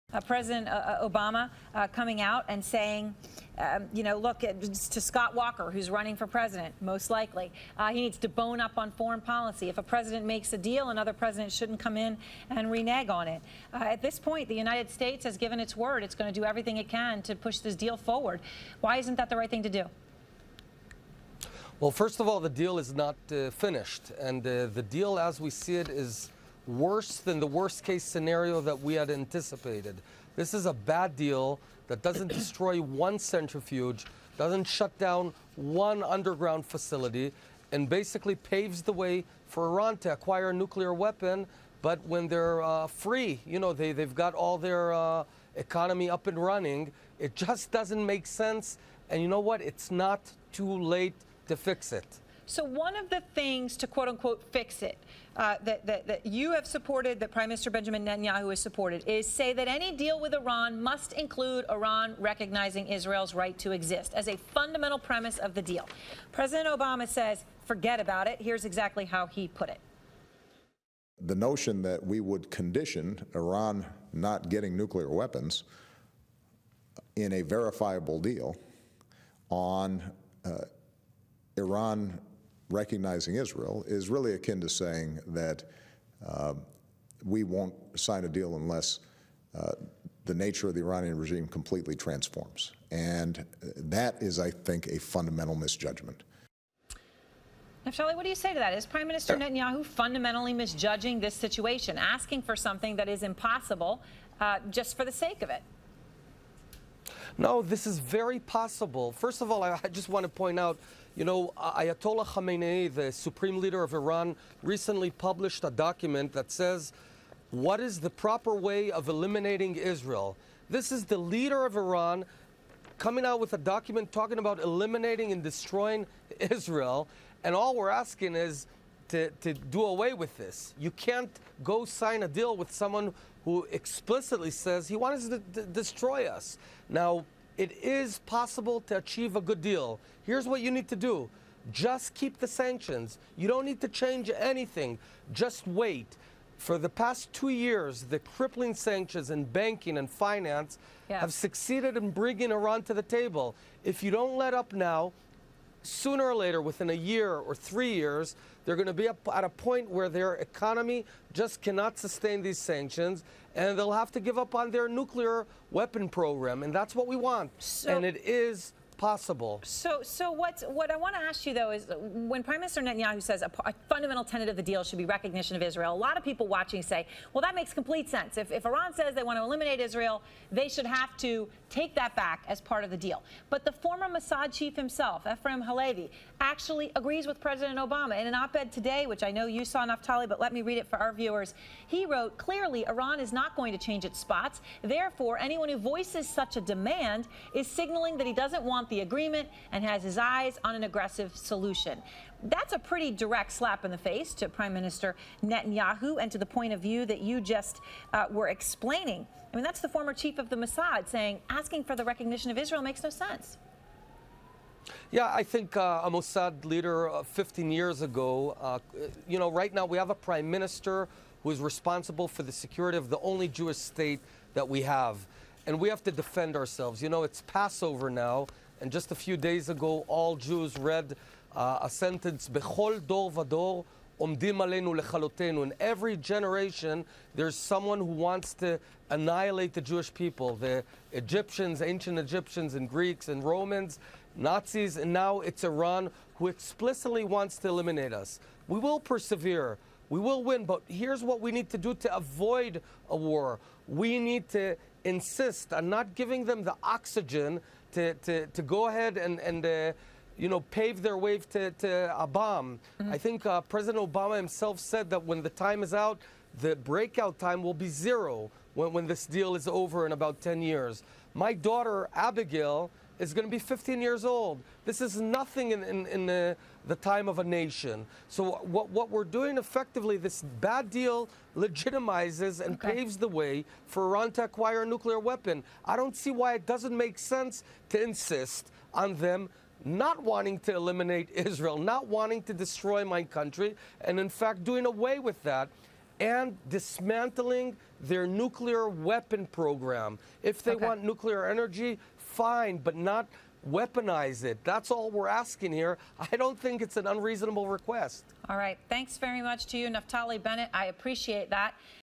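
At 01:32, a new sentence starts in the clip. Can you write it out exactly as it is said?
And uh, that is, I think, a fundamental misjudgment.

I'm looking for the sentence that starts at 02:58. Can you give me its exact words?
If, if Iran says they want to eliminate Israel, they should have to take that back as part of the deal.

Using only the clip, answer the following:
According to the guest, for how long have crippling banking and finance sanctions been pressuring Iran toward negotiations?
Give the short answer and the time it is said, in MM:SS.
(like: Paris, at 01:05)
2 years, at 02:27.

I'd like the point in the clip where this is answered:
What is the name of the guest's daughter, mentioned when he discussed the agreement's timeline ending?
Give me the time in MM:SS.
04:32.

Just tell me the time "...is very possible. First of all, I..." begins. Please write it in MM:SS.
01:47.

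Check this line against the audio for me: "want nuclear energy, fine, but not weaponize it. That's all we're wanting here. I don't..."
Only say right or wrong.
wrong.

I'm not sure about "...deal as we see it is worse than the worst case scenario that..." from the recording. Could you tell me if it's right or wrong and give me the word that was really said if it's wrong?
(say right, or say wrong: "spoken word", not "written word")
right.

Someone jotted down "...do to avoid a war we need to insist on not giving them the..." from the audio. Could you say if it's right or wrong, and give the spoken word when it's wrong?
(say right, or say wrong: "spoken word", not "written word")
right.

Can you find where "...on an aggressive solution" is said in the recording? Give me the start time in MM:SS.
03:20.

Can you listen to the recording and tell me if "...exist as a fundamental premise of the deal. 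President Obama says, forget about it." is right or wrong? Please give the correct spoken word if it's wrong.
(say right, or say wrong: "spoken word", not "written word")
right.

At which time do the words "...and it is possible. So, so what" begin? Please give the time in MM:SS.
02:47.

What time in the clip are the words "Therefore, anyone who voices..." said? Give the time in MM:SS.
03:14.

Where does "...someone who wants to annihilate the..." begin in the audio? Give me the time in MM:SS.
03:57.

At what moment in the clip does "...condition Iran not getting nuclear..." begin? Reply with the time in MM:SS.
01:12.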